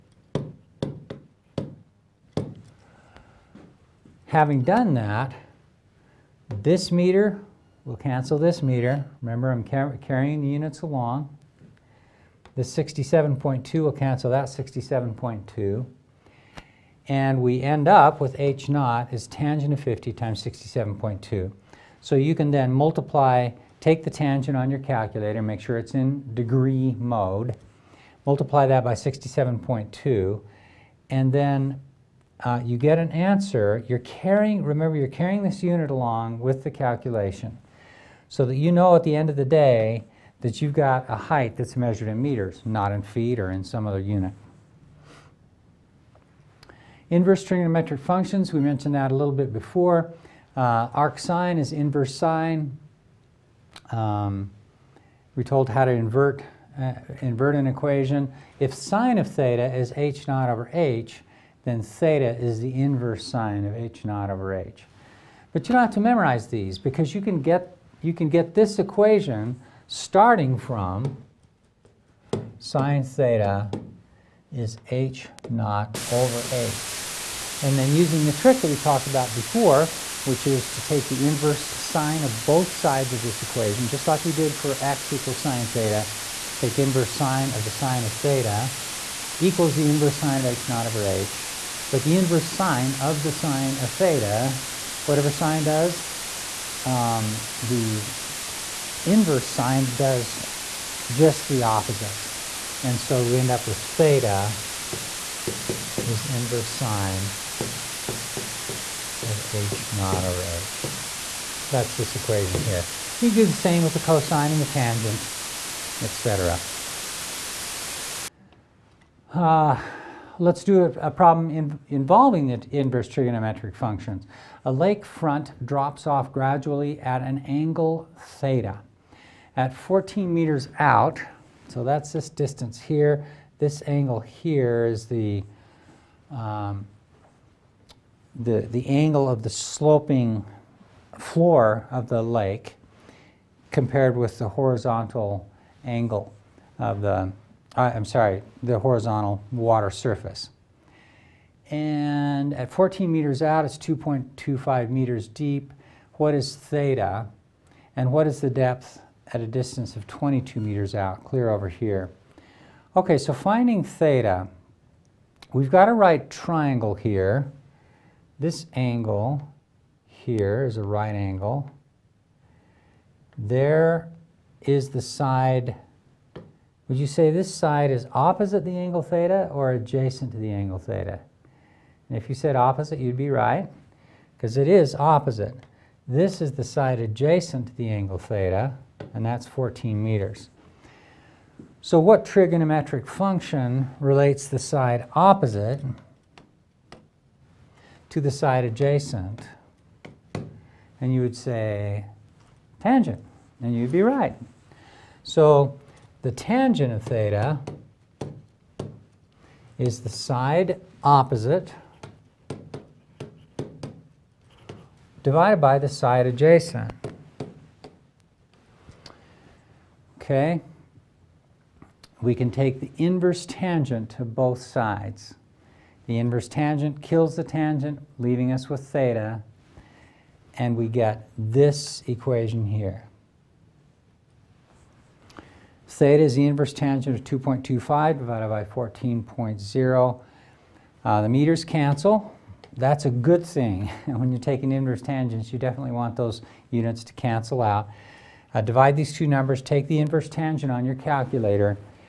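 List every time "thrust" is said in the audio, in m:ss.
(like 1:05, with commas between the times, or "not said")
not said.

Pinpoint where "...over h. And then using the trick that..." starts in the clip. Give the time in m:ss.
1:16.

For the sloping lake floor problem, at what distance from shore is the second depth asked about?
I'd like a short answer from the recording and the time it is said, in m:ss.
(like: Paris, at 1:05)
22 meters, at 2:40.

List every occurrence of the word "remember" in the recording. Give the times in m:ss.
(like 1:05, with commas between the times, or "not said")
0:09, 0:34.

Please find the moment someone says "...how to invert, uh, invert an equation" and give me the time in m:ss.
0:55.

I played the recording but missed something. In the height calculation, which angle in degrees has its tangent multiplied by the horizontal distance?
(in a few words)
50.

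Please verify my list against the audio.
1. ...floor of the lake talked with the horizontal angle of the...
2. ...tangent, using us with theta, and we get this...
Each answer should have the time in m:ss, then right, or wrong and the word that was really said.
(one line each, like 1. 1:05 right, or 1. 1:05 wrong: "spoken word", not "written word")
1. 2:21 wrong: "compared", not "talked"
2. 3:47 wrong: "leaving", not "using".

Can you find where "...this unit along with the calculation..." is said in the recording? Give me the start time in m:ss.
0:35.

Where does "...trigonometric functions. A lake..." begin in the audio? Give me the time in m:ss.
2:03.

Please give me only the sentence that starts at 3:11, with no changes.
So what trigonometric function relates the side opposite to the side adjacent.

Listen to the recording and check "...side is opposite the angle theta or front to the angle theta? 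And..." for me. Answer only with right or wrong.
wrong.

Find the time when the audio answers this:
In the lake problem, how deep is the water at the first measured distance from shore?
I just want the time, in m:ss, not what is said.
2:33.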